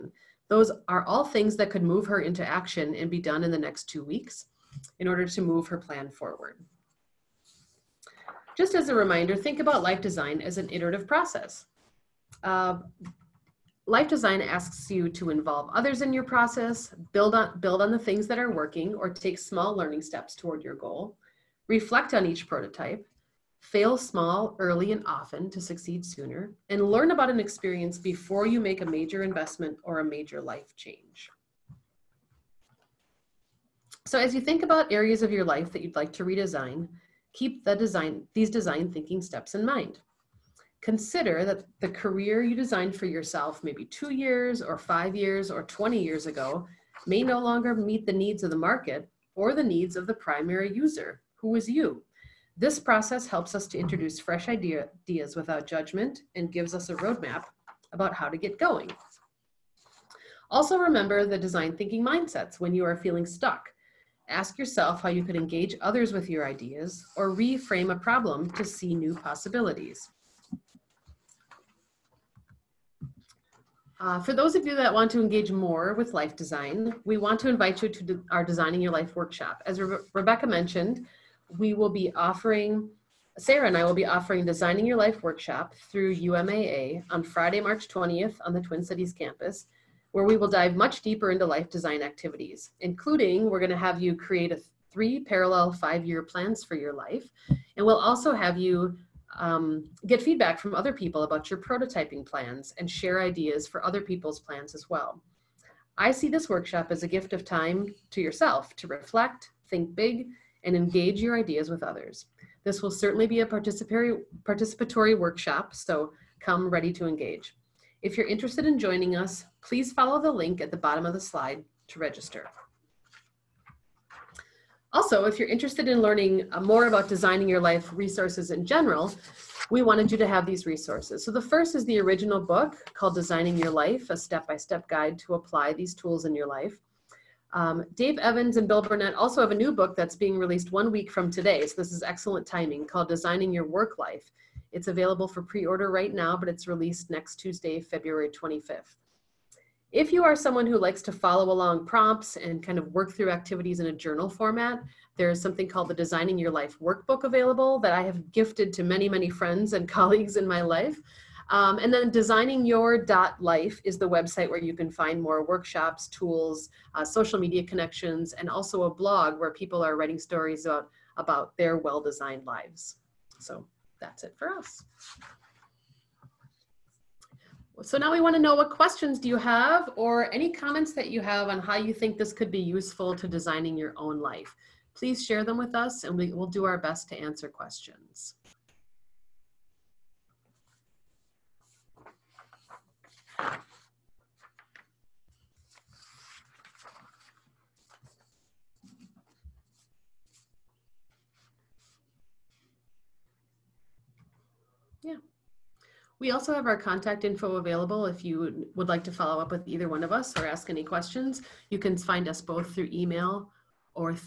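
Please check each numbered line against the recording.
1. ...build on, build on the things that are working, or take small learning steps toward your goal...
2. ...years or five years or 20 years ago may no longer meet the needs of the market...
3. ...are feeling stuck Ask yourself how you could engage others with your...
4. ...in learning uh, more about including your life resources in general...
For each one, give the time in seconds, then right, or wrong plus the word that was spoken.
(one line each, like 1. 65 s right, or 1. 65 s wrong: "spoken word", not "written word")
1. 17 s right
2. 44 s right
3. 62 s right
4. 125 s wrong: "designing", not "including".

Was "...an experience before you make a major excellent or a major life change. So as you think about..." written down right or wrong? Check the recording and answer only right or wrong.
wrong.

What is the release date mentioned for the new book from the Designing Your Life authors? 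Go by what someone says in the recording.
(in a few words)
February 25th.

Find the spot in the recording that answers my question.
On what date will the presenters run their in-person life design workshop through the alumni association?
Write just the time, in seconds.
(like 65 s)
87 s.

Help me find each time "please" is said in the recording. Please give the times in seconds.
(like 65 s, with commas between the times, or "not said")
119 s, 184 s.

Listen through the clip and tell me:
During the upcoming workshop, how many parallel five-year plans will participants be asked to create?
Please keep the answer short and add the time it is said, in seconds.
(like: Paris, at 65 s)
3, at 94 s.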